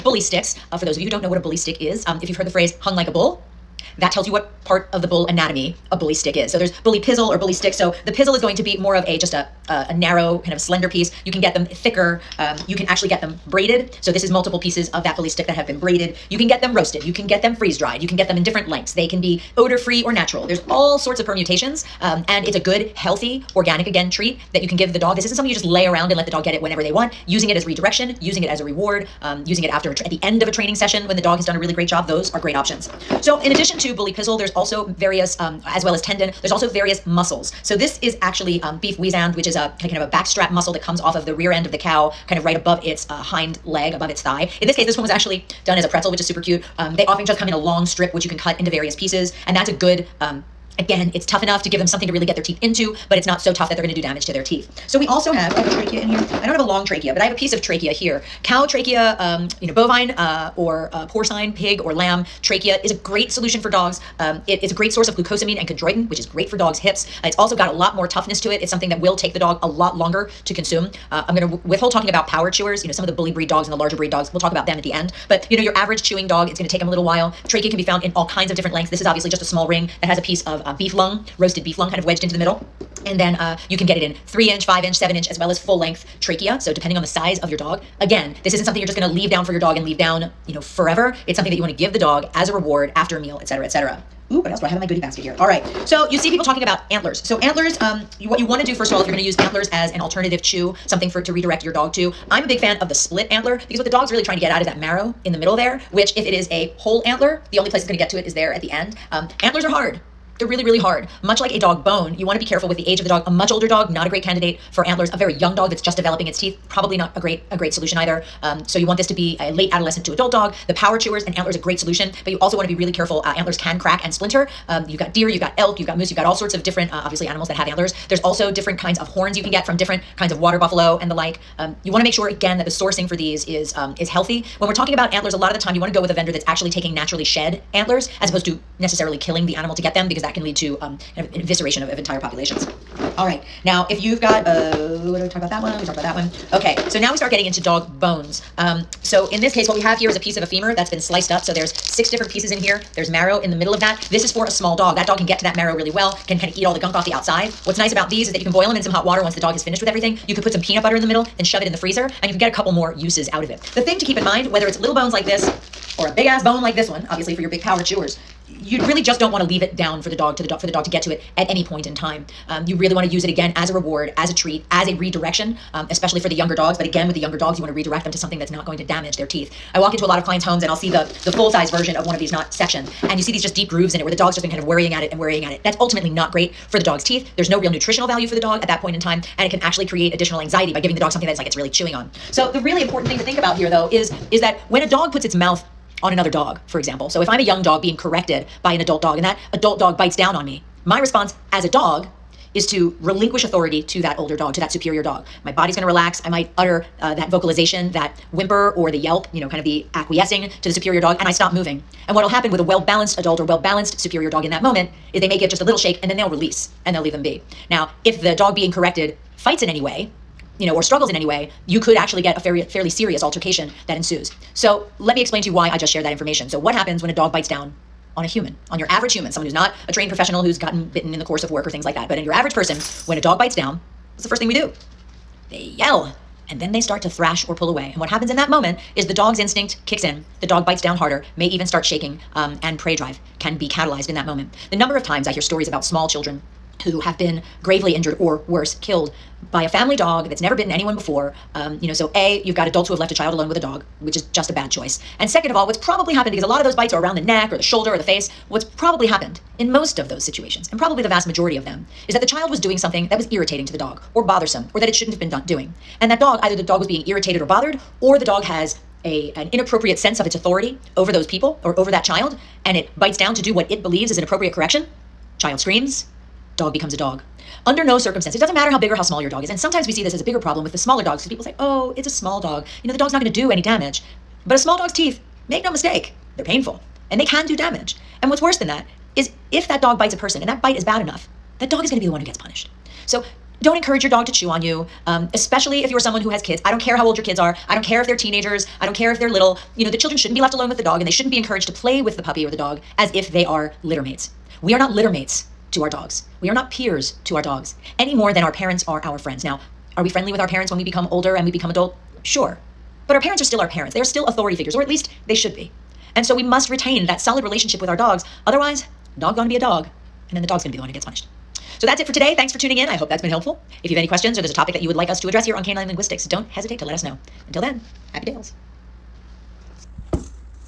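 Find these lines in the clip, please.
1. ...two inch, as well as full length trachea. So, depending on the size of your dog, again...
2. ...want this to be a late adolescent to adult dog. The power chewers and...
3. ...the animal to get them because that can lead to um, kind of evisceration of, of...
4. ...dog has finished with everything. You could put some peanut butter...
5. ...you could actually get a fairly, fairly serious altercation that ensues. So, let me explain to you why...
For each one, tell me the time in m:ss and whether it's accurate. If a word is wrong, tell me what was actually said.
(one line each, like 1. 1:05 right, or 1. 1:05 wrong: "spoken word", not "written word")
1. 1:24 wrong: "seven", not "two"
2. 1:58 right
3. 2:19 right
4. 2:39 right
5. 3:41 right.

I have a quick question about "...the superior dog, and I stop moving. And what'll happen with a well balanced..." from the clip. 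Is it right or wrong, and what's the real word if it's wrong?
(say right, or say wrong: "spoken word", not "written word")
right.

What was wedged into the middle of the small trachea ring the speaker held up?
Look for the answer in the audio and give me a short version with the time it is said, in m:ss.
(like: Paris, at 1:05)
Roasted beef lung, at 1:21.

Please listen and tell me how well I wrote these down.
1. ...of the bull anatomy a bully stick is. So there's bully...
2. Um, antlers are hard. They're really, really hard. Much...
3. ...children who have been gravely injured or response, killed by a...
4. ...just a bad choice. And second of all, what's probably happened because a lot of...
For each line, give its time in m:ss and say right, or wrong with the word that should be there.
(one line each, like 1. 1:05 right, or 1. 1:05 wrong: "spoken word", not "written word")
1. 0:04 right
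2. 1:49 right
3. 4:06 wrong: "worse", not "response"
4. 4:14 right.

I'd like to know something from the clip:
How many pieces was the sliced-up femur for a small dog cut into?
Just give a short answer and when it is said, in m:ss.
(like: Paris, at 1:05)
6, at 2:31.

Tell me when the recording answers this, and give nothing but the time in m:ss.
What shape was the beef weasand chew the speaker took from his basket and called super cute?
0:45.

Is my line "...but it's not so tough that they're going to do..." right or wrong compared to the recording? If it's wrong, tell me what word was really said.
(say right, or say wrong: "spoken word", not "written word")
right.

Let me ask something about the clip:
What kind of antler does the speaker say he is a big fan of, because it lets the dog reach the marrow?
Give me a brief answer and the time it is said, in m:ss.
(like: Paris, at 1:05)
Split antler, at 1:42.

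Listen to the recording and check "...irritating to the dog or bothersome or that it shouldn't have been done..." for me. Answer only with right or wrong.
right.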